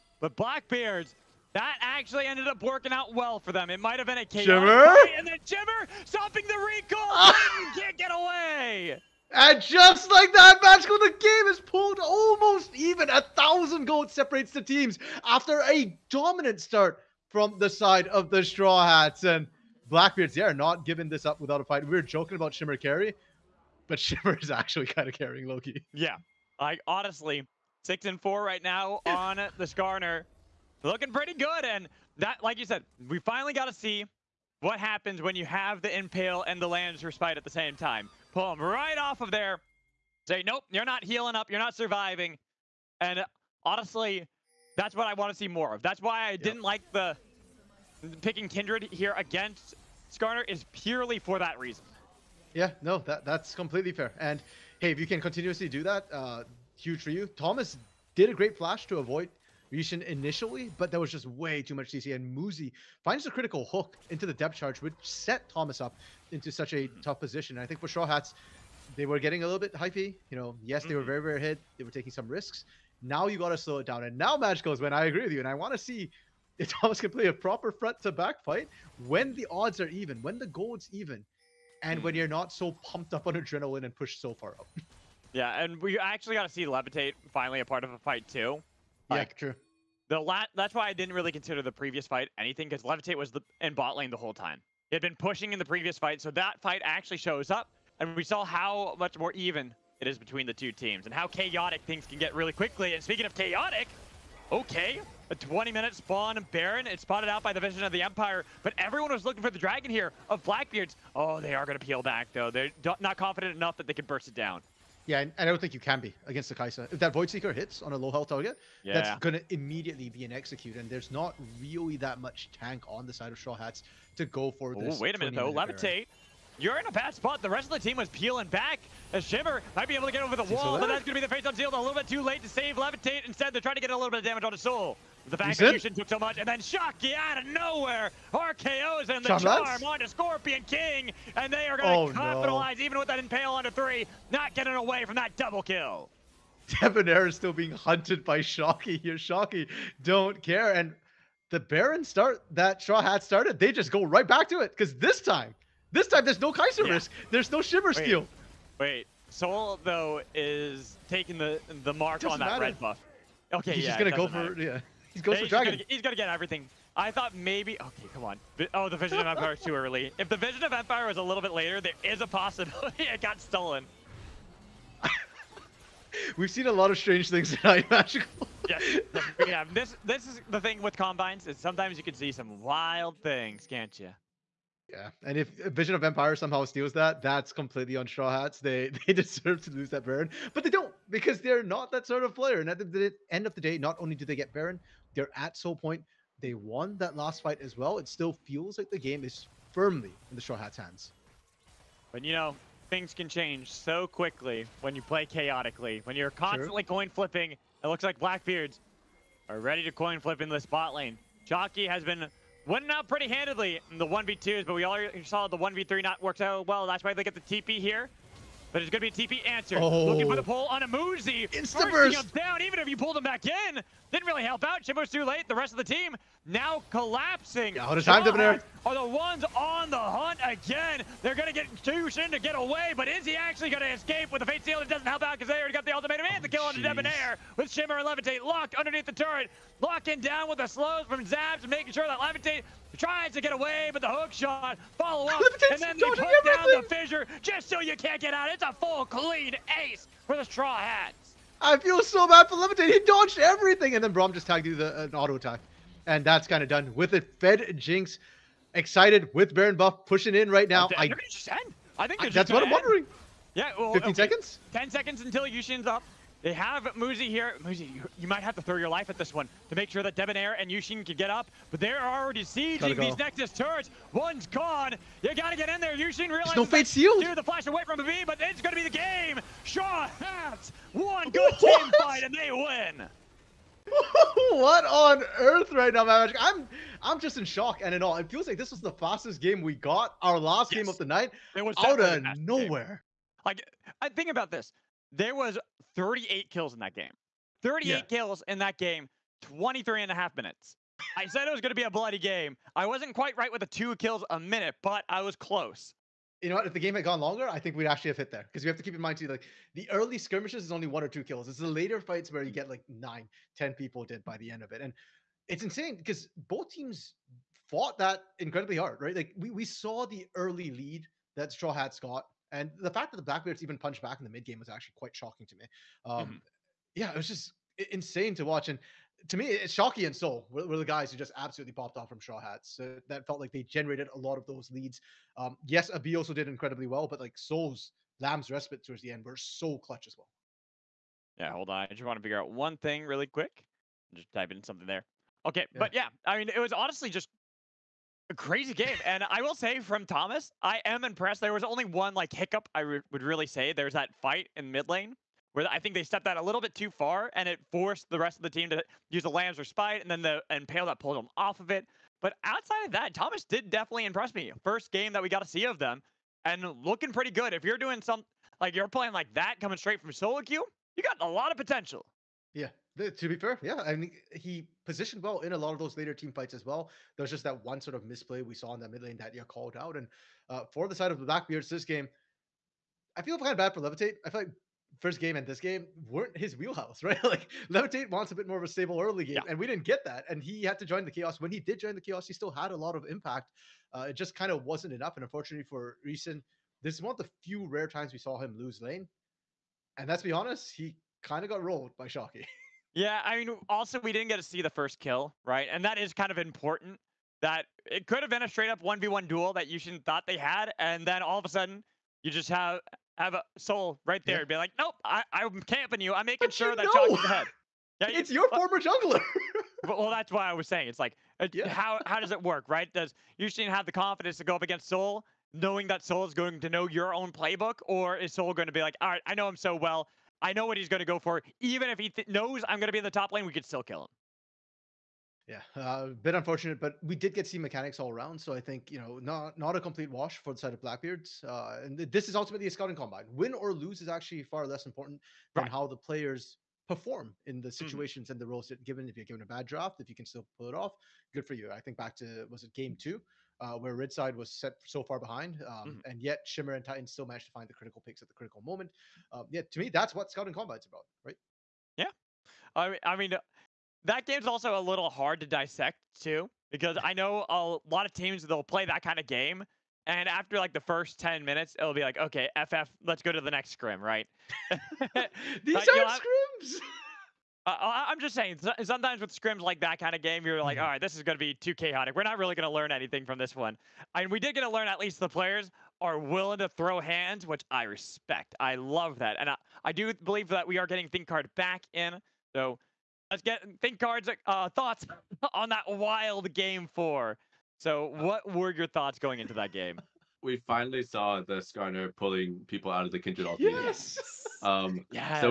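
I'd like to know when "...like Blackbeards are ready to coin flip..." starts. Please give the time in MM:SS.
03:28.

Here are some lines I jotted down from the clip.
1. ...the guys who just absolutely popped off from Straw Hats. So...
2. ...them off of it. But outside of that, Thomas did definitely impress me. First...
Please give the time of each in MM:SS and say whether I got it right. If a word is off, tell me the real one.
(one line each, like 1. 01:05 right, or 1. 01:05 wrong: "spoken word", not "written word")
1. 05:30 right
2. 06:01 right.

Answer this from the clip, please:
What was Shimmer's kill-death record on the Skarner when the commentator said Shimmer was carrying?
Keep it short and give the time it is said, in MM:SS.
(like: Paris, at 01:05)
6 and 4, at 00:27.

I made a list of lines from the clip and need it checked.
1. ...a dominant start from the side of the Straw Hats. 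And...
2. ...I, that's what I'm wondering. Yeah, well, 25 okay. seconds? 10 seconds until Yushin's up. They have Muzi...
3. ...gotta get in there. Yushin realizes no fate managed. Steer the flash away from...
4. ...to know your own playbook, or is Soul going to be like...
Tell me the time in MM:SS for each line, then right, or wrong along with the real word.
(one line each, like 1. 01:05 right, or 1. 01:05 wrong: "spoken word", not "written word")
1. 00:15 right
2. 04:22 wrong: "15", not "25"
3. 04:35 wrong: "sealed", not "managed"
4. 07:06 right.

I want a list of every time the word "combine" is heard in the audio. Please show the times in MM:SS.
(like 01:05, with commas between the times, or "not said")
03:00, 07:22, 07:40.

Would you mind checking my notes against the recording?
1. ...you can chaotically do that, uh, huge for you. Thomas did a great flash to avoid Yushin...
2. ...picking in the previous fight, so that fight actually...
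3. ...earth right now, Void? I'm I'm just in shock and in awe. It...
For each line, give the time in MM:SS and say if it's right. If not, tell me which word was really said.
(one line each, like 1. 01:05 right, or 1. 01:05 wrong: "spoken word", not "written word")
1. 00:54 wrong: "continuously", not "chaotically"
2. 01:35 wrong: "pushing", not "picking"
3. 04:45 wrong: "Magic", not "Void".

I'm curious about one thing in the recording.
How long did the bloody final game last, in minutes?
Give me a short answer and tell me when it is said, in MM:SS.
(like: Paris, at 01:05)
23 and a half, at 04:59.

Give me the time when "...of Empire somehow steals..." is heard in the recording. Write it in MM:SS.
03:05.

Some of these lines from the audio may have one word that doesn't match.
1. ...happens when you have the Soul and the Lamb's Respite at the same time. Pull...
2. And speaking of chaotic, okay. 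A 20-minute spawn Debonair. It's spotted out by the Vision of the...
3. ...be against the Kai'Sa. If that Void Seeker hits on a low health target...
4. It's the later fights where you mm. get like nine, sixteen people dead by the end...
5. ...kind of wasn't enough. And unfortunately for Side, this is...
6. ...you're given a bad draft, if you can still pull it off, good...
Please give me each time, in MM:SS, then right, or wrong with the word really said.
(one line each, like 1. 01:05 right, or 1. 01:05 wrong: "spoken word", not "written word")
1. 00:34 wrong: "Impale", not "Soul"
2. 01:42 wrong: "Baron", not "Debonair"
3. 01:55 right
4. 05:11 wrong: "ten", not "sixteen"
5. 06:34 wrong: "Reason", not "Side"
6. 07:29 right.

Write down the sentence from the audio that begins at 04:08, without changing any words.
It's a full clean ace for the Straw Hats.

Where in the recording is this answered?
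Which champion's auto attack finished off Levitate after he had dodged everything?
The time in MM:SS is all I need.
04:14.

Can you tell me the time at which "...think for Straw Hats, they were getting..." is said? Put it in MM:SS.
01:07.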